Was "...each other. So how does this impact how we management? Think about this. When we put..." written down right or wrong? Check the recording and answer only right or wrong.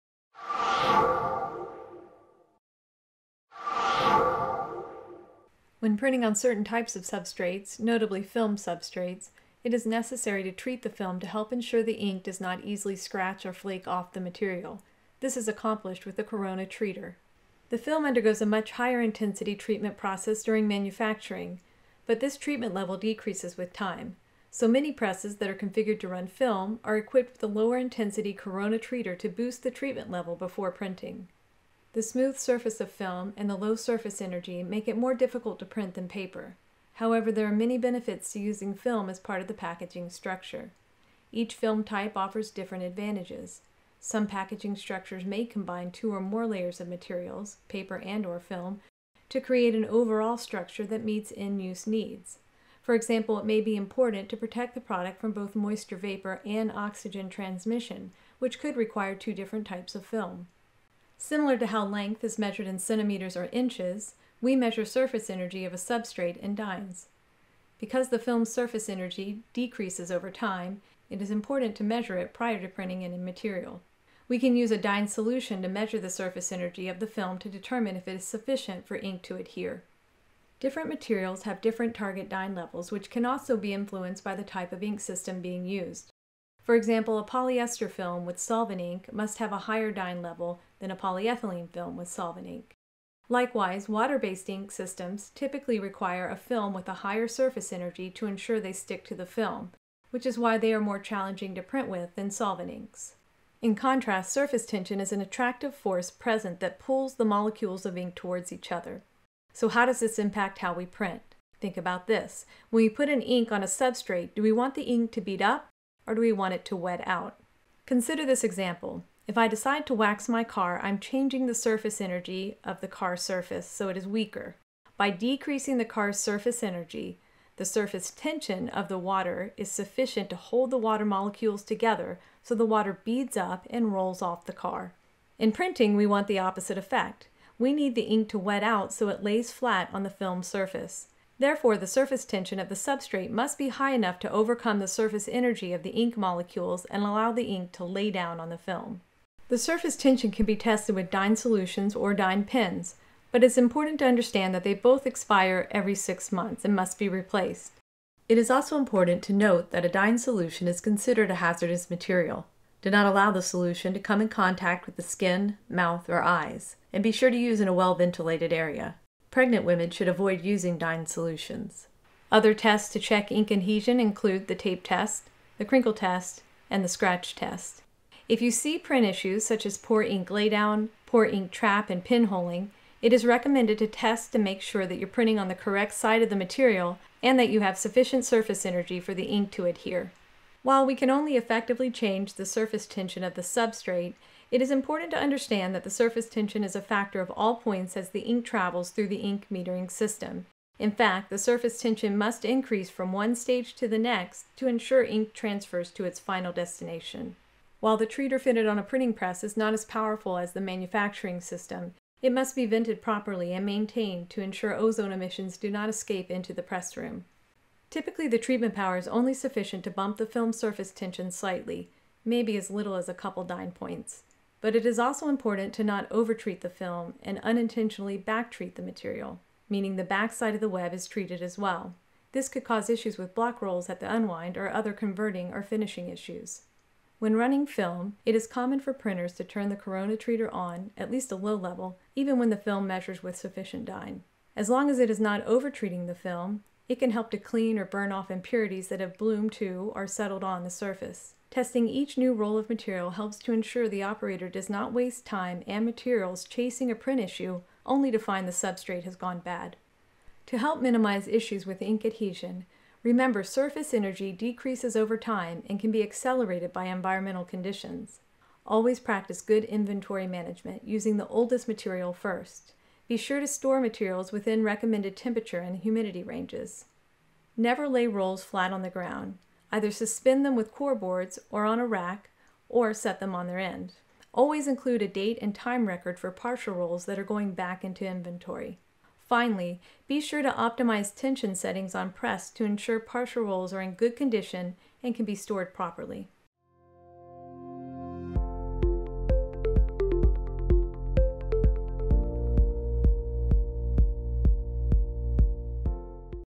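wrong.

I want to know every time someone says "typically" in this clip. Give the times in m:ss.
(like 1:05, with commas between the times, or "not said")
1:35, 3:37.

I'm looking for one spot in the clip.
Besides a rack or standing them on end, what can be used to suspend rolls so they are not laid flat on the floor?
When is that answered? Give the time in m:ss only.
4:40.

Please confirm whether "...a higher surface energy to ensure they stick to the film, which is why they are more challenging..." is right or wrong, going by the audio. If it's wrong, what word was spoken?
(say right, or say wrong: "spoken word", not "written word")
right.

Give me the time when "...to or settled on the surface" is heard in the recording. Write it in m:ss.
4:09.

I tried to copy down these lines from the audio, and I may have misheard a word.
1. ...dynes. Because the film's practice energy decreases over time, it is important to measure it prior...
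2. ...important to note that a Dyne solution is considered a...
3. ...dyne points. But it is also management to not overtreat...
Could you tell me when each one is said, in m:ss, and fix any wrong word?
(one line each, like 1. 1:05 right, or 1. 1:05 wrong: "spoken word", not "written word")
1. 1:06 wrong: "surface", not "practice"
2. 2:38 right
3. 3:43 wrong: "important", not "management".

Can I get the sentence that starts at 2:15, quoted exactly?
In printing, we want the opposite effect.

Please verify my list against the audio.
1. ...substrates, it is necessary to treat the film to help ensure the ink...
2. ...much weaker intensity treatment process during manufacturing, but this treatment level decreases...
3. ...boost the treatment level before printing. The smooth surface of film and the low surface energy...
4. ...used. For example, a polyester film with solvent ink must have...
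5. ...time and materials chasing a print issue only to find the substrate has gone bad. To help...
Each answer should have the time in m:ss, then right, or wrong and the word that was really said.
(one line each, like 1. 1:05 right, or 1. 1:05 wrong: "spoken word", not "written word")
1. 0:08 right
2. 0:18 wrong: "higher", not "weaker"
3. 0:29 right
4. 1:25 right
5. 4:15 right.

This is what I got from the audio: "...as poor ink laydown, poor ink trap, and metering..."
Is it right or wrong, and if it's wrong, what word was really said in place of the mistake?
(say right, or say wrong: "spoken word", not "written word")
wrong: "pinholing", not "metering".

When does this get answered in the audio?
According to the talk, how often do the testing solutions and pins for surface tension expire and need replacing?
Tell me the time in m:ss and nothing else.
2:35.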